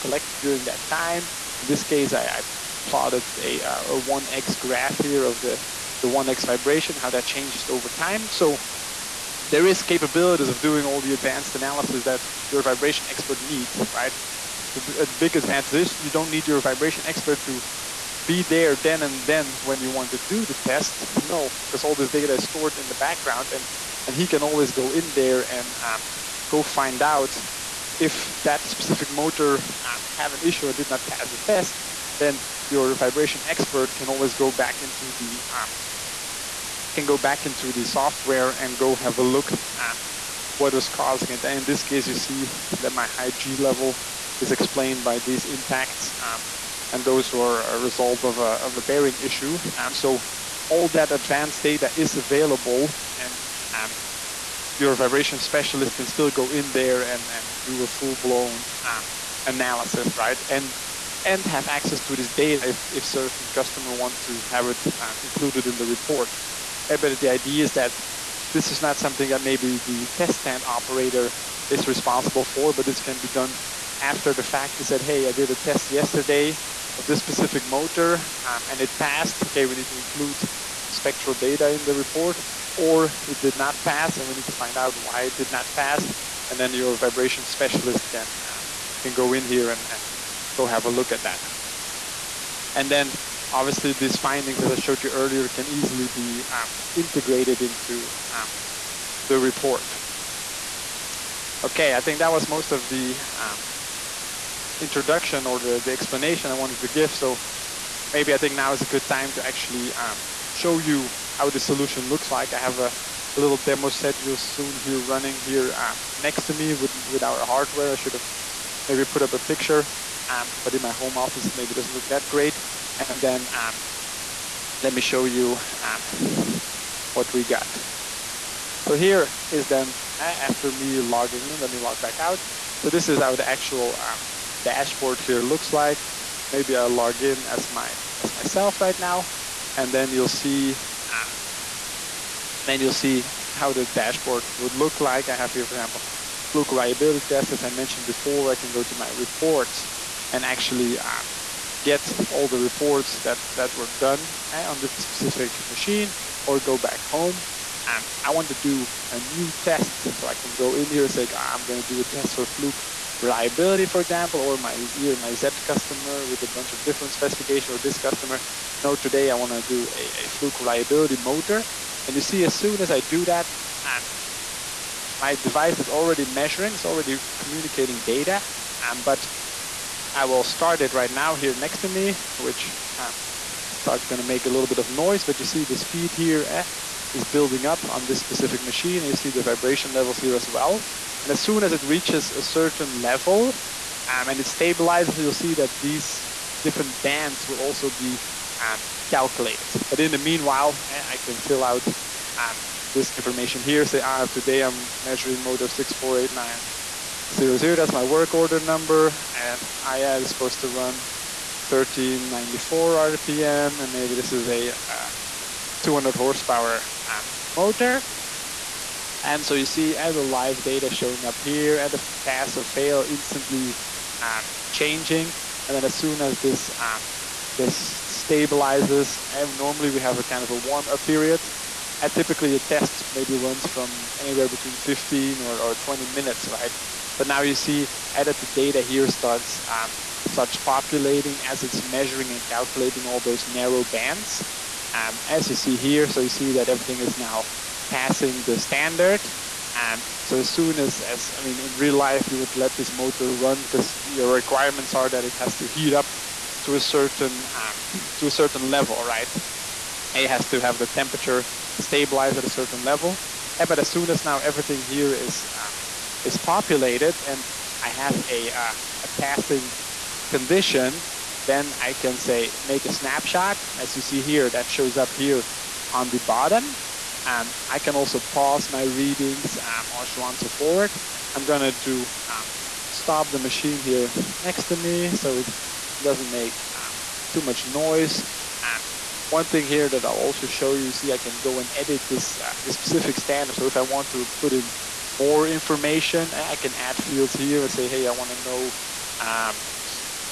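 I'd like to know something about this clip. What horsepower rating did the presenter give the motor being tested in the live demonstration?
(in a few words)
200.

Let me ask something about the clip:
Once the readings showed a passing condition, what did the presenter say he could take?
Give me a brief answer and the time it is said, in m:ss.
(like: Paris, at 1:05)
snapshot, at 4:32.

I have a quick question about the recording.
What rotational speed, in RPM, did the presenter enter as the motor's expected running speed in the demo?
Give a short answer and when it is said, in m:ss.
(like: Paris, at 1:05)
1394, at 3:31.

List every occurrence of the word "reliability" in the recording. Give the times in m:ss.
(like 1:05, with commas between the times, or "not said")
2:26, 2:43, 2:50.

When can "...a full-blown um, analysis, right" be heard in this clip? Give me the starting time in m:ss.
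0:57.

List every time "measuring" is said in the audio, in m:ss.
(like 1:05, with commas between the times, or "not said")
2:56, 3:25, 4:01.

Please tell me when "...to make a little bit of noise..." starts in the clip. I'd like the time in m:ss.
3:04.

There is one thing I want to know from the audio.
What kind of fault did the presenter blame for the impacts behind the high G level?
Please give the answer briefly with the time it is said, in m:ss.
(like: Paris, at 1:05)
bearing issue, at 0:48.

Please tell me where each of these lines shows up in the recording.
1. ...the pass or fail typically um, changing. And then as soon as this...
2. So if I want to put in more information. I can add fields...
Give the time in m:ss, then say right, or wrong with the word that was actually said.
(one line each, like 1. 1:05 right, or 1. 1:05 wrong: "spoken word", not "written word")
1. 3:41 wrong: "instantly", not "typically"
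2. 4:53 right.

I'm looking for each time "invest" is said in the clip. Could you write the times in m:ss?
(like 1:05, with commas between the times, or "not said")
not said.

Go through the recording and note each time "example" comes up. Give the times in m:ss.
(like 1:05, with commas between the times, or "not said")
2:25, 2:44.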